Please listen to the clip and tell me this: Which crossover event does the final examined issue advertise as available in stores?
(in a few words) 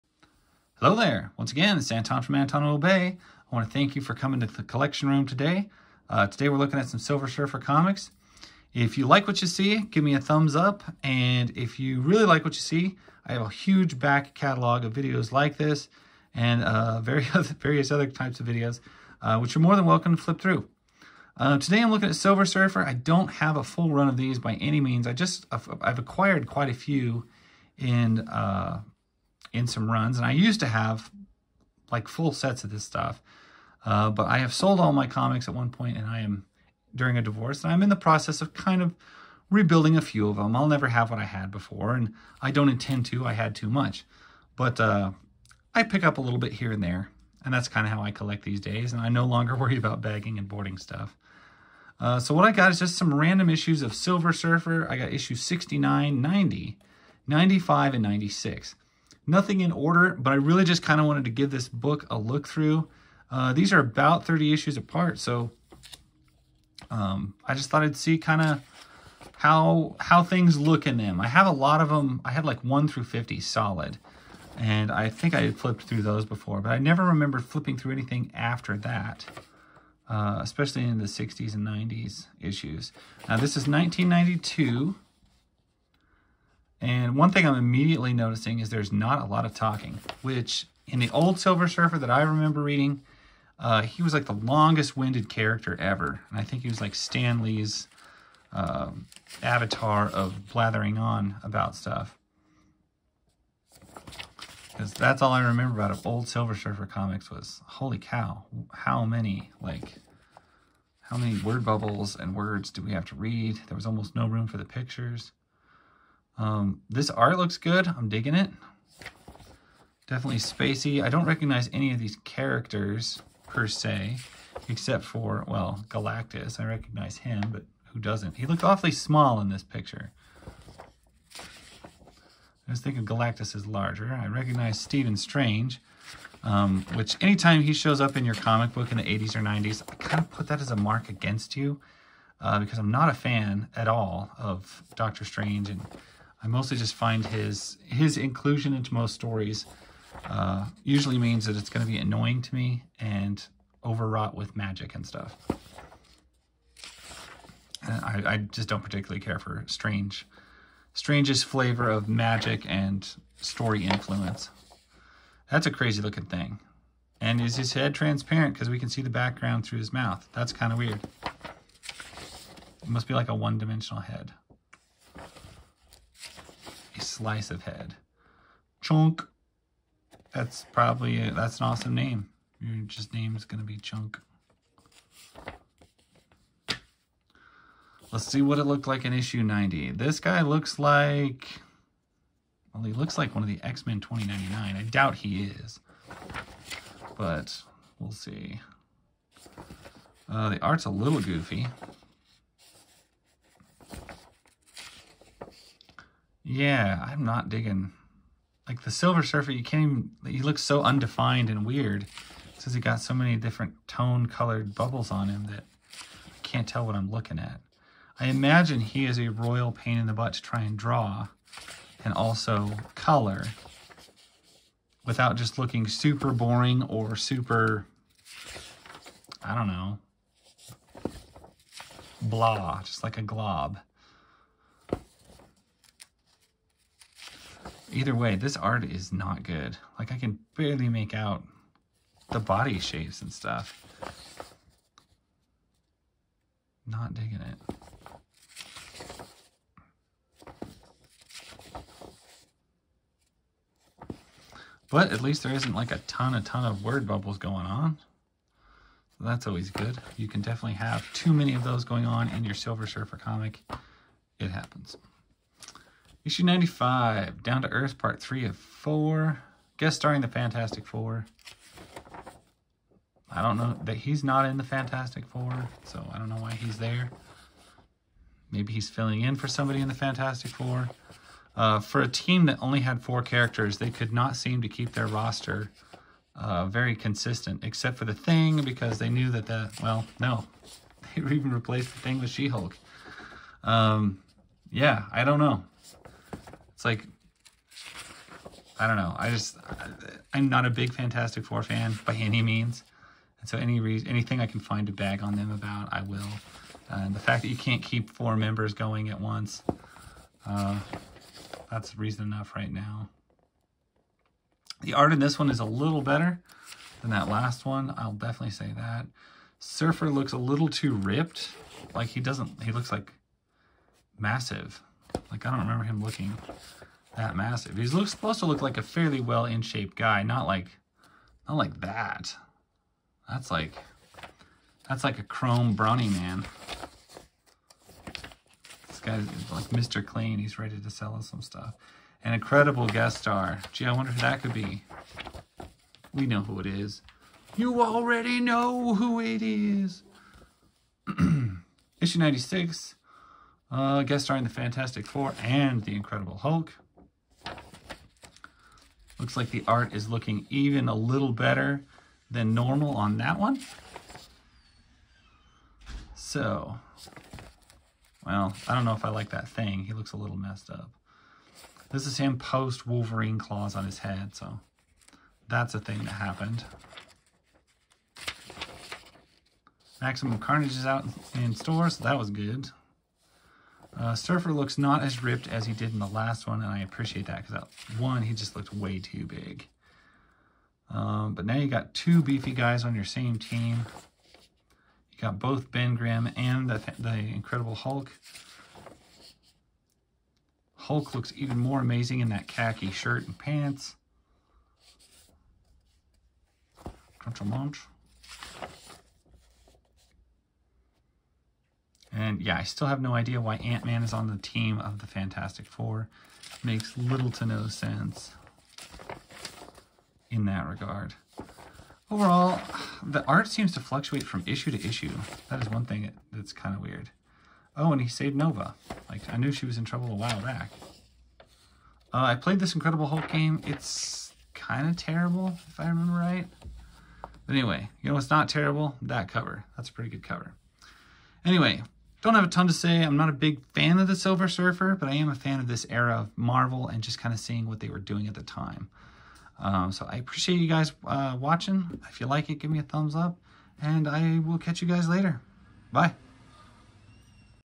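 Maximum Carnage.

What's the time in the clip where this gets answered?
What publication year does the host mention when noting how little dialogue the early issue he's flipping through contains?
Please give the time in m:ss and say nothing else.
1:23.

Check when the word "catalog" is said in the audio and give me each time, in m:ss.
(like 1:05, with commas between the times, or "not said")
0:14.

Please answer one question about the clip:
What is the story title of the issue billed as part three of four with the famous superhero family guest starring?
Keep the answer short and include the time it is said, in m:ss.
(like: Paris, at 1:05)
Down to Earth, at 4:27.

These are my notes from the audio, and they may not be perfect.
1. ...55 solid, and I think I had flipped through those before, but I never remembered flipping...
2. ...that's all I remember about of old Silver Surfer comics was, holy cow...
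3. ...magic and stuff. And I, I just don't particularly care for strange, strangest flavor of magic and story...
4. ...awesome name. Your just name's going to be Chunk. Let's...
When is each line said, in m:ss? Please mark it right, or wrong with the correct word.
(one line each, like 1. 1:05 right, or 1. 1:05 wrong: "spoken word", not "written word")
1. 1:13 wrong: "50", not "55"
2. 1:44 right
3. 2:34 right
4. 3:01 right.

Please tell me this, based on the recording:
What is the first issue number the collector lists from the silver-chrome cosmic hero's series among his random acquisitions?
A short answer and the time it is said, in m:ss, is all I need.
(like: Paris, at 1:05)
69, at 0:55.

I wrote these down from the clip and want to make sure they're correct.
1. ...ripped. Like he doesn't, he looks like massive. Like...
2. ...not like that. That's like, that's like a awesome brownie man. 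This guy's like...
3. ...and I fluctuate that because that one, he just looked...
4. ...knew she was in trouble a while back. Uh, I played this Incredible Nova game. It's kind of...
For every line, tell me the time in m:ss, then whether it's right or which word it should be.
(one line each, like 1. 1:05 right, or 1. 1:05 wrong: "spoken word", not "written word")
1. 5:20 right
2. 5:31 wrong: "chrome", not "awesome"
3. 6:26 wrong: "appreciate", not "fluctuate"
4. 7:09 wrong: "Hulk", not "Nova".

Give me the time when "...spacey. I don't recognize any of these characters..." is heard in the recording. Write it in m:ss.
2:00.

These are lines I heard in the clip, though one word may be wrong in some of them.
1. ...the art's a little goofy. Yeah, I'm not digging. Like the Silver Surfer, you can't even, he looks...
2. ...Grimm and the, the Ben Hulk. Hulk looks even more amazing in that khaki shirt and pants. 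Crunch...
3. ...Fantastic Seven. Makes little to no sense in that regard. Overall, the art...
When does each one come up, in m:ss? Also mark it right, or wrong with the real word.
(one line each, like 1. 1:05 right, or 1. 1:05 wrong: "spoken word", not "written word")
1. 3:20 right
2. 6:35 wrong: "Incredible", not "Ben"
3. 6:55 wrong: "Four", not "Seven".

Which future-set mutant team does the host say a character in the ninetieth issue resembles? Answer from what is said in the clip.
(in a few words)
X-Men 2099.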